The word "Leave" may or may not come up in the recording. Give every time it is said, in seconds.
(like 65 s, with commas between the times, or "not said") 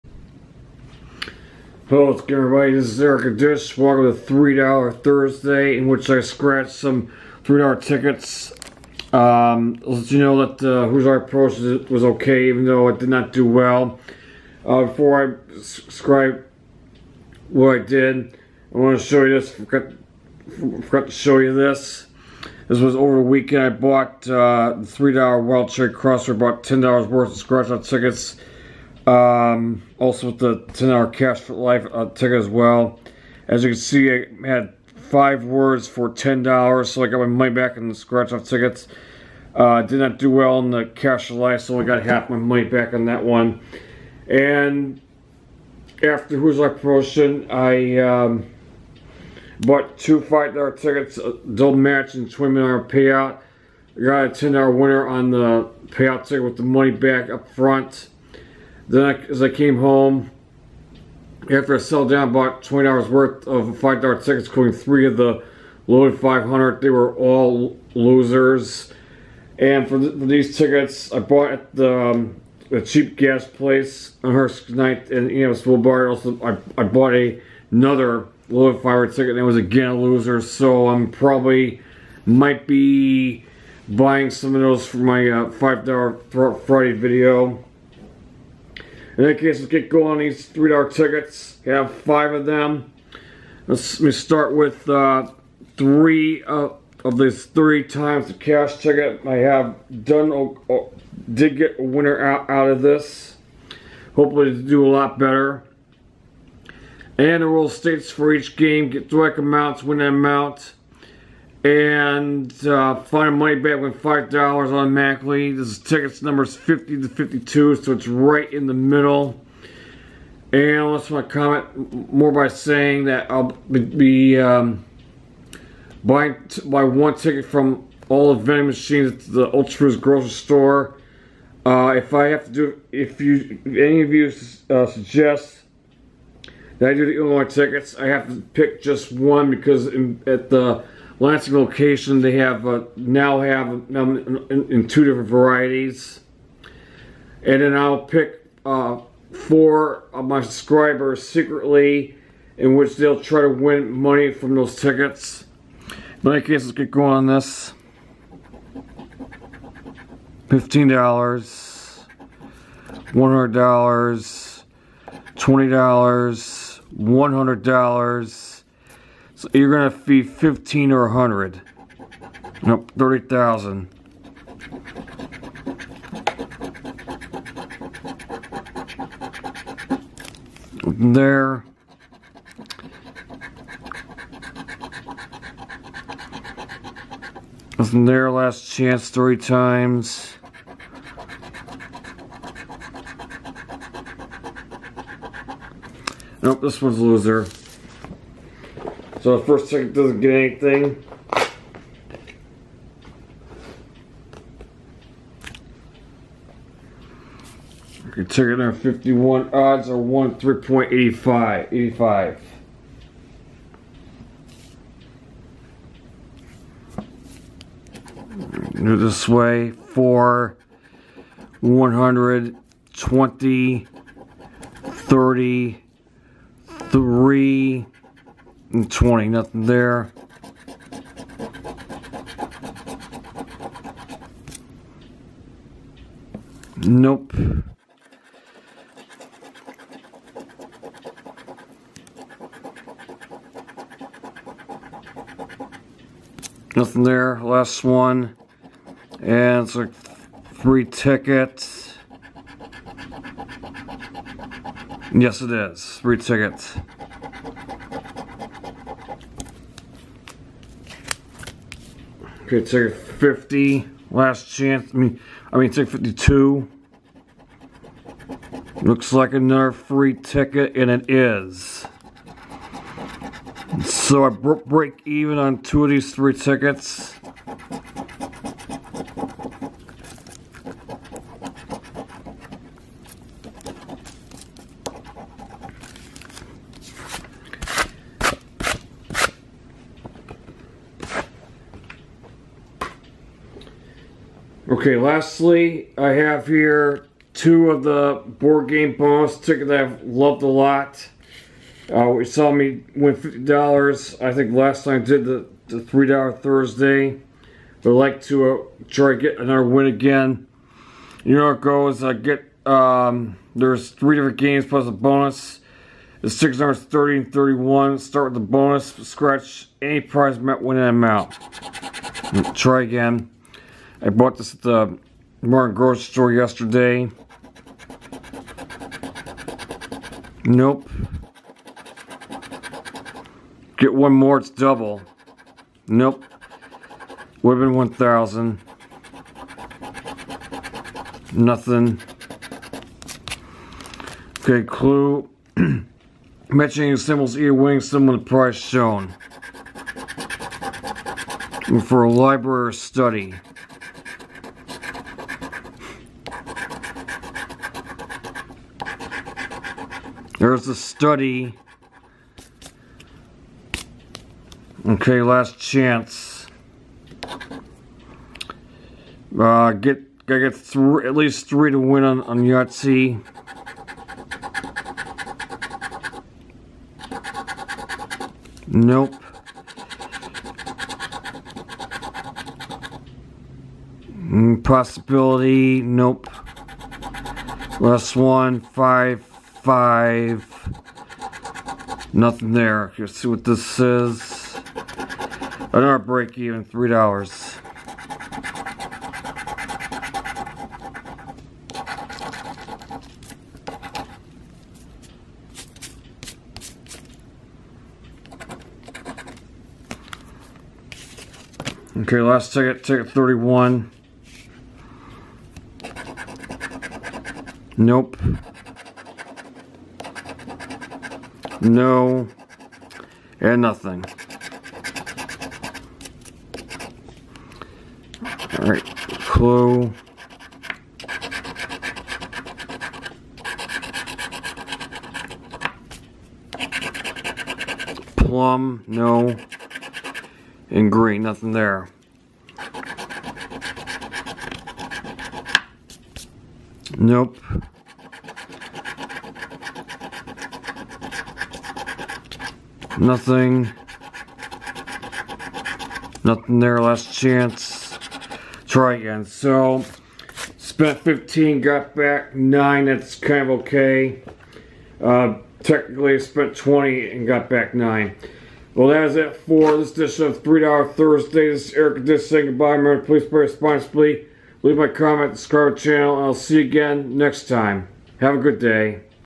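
474 s.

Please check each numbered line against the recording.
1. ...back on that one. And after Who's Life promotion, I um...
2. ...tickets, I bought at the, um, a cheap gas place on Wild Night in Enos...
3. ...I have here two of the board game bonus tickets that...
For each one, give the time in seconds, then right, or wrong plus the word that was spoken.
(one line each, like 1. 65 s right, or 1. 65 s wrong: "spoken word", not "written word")
1. 42 s right
2. 70 s wrong: "Hearst", not "Wild"
3. 295 s right.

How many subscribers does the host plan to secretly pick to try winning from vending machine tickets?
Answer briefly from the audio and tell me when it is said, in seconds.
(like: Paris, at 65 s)
4, at 149 s.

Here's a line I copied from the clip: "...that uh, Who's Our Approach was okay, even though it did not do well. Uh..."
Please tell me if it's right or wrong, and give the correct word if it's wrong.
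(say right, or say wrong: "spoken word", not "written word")
right.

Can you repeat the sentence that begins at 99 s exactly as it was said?
I have done uh, did get a winner out out of this.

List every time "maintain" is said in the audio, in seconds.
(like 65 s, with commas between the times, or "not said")
not said.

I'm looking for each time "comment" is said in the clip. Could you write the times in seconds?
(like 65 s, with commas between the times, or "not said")
121 s, 474 s.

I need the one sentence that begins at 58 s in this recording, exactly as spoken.
Then I, as I came home, after I sold down, bought $20 worth of $5 tickets, including three of the loaded 500.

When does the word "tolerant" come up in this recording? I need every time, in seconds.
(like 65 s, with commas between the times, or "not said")
not said.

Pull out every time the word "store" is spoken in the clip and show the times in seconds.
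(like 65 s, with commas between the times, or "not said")
130 s, 326 s.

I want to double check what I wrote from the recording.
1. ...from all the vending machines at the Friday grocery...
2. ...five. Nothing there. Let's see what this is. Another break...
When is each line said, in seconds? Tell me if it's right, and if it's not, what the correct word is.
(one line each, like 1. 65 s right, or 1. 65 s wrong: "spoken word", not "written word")
1. 127 s wrong: "Ultra", not "Friday"
2. 389 s right.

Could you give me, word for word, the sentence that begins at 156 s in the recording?
In in case, let's get going on this.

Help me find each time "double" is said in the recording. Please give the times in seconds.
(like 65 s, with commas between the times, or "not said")
51 s, 334 s.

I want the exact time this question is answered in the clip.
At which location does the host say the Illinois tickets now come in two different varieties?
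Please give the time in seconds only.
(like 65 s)
141 s.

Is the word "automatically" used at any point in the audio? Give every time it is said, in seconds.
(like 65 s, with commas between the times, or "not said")
114 s.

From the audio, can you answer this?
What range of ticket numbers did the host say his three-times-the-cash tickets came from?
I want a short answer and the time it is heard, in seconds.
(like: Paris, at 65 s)
50 to 52, at 116 s.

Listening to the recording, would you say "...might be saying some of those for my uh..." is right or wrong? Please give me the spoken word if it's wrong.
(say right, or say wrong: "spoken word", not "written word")
wrong: "buying", not "saying".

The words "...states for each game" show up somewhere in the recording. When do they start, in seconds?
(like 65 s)
107 s.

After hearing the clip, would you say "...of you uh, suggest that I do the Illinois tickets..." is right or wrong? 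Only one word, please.
right.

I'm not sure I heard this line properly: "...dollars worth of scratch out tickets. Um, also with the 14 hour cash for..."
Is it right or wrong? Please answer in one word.
wrong.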